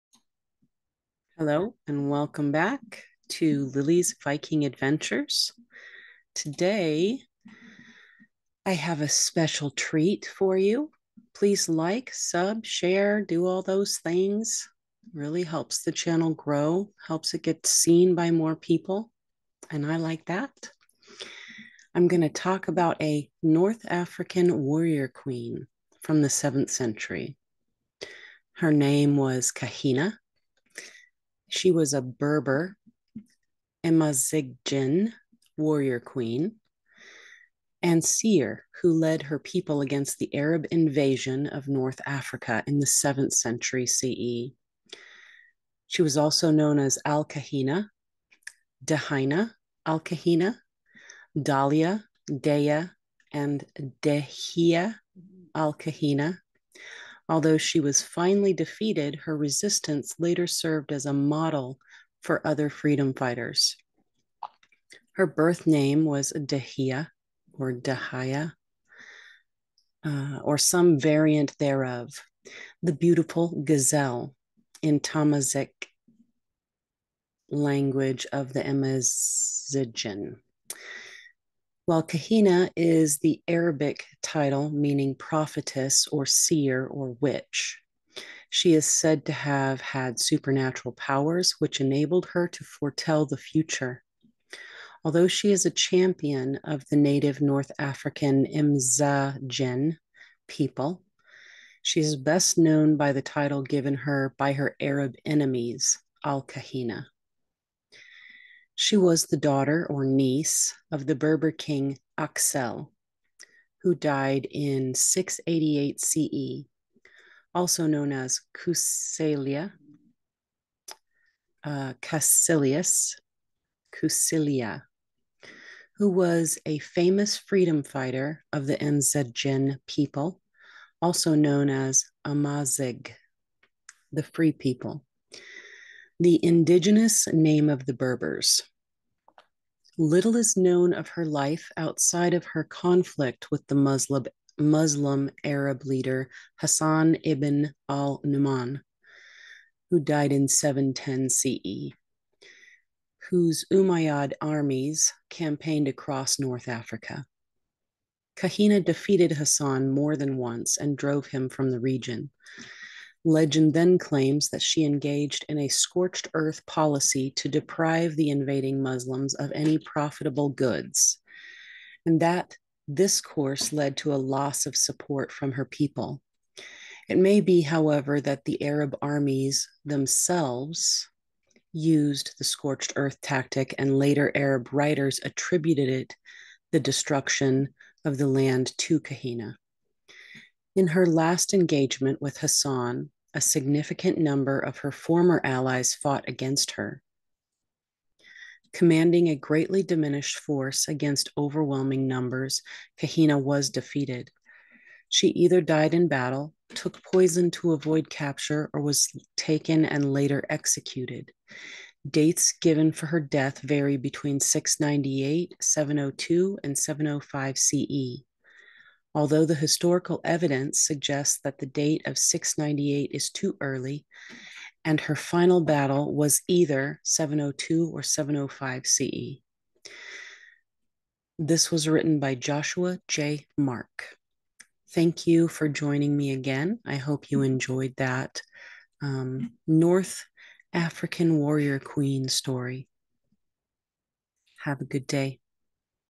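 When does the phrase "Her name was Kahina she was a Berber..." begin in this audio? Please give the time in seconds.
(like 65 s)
28 s.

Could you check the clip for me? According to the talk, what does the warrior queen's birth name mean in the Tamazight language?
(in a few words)
the beautiful gazelle.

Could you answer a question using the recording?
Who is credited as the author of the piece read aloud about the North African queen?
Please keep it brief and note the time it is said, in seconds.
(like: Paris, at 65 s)
Joshua J. Mark, at 232 s.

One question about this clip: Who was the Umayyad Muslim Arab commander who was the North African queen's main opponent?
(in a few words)
Hassan ibn al Numan.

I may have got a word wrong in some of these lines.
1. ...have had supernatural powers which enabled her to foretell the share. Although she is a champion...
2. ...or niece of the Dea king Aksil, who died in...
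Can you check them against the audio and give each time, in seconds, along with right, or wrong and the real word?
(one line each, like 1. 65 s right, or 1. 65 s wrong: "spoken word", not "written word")
1. 89 s wrong: "future", not "share"
2. 109 s wrong: "Berber", not "Dea".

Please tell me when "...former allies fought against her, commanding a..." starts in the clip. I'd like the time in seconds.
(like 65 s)
194 s.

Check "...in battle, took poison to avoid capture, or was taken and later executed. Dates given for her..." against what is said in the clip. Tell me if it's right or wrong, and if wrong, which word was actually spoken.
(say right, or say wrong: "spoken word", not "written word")
right.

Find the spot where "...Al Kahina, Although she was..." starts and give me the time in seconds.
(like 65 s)
55 s.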